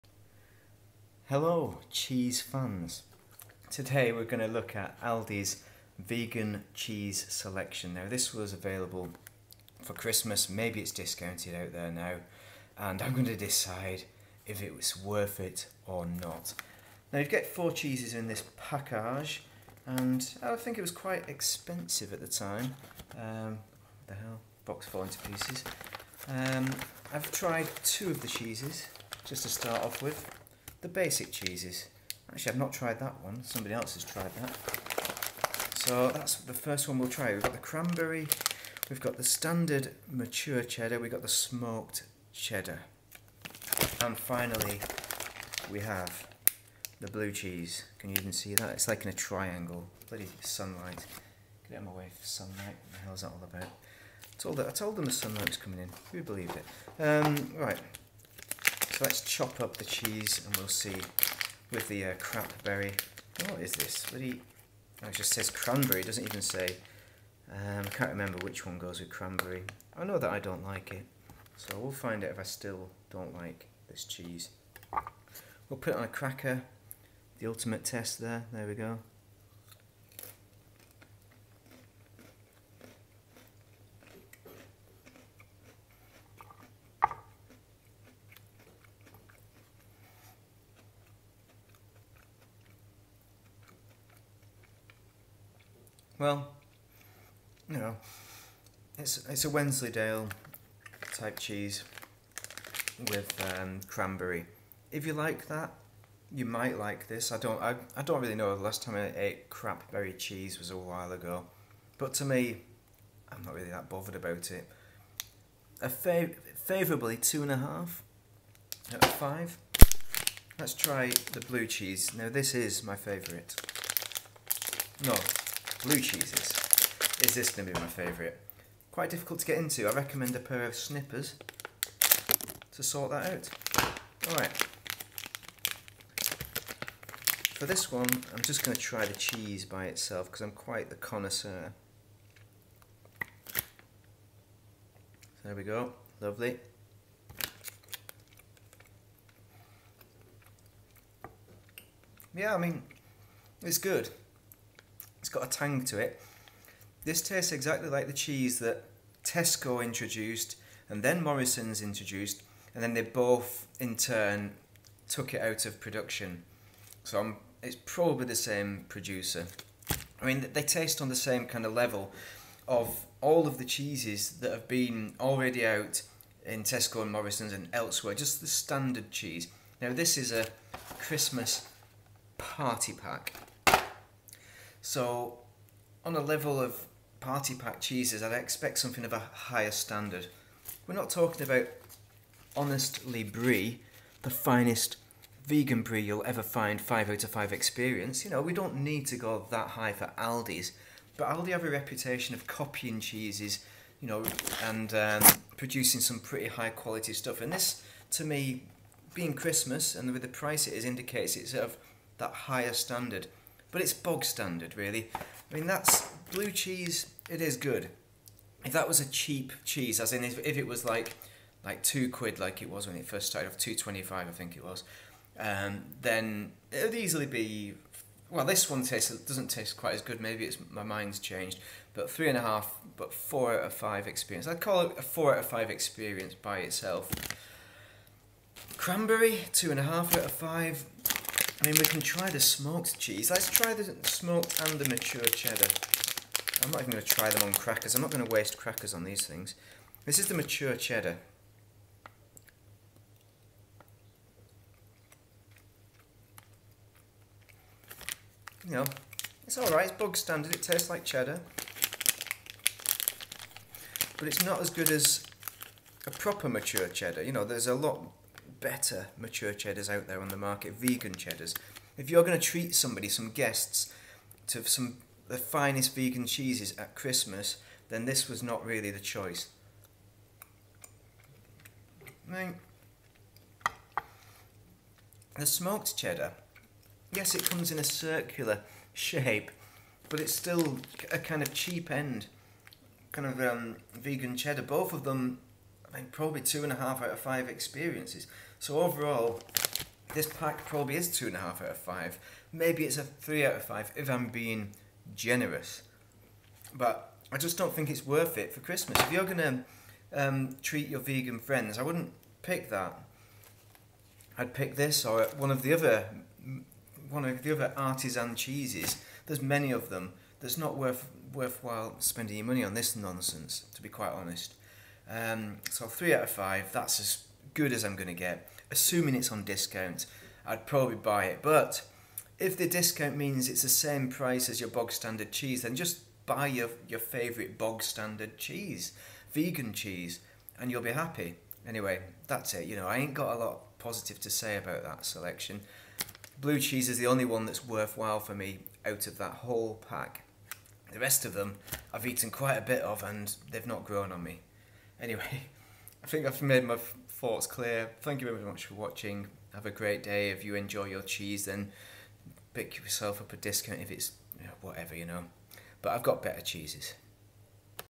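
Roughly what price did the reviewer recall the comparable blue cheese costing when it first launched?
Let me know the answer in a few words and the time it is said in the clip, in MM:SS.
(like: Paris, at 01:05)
2.25, at 03:43.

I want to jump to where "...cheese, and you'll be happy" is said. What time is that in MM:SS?
05:39.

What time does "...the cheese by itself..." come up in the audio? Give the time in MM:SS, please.
02:19.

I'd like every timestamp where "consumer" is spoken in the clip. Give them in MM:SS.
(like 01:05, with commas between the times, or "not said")
not said.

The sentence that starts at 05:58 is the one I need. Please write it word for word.
Thank you very much for watching.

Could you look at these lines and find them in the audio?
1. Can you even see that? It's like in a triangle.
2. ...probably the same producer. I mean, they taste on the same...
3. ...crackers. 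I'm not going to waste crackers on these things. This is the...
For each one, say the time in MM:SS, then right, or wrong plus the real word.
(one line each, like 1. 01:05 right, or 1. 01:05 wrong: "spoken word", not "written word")
1. 00:47 right
2. 02:47 right
3. 04:07 right.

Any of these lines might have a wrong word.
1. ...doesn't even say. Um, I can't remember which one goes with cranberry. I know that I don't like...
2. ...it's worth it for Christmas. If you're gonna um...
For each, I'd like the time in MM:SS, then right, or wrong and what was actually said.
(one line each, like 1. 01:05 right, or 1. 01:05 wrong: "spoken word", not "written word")
1. 01:06 right
2. 05:07 right.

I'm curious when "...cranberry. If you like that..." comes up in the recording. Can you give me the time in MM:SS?
01:43.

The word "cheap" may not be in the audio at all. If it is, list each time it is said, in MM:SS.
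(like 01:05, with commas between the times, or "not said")
03:39, 04:51.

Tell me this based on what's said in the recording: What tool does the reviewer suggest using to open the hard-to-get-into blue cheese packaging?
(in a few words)
A pair of snippers.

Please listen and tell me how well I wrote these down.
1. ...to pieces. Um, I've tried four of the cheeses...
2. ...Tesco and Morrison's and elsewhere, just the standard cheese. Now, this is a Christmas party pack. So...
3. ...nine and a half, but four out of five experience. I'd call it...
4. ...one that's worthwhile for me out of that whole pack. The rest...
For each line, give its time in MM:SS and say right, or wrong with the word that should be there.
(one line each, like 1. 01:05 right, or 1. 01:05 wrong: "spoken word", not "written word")
1. 00:25 wrong: "two", not "four"
2. 02:56 right
3. 03:52 wrong: "three", not "nine"
4. 05:47 right.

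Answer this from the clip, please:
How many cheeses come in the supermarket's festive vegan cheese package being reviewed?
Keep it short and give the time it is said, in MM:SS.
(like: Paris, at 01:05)
4, at 00:17.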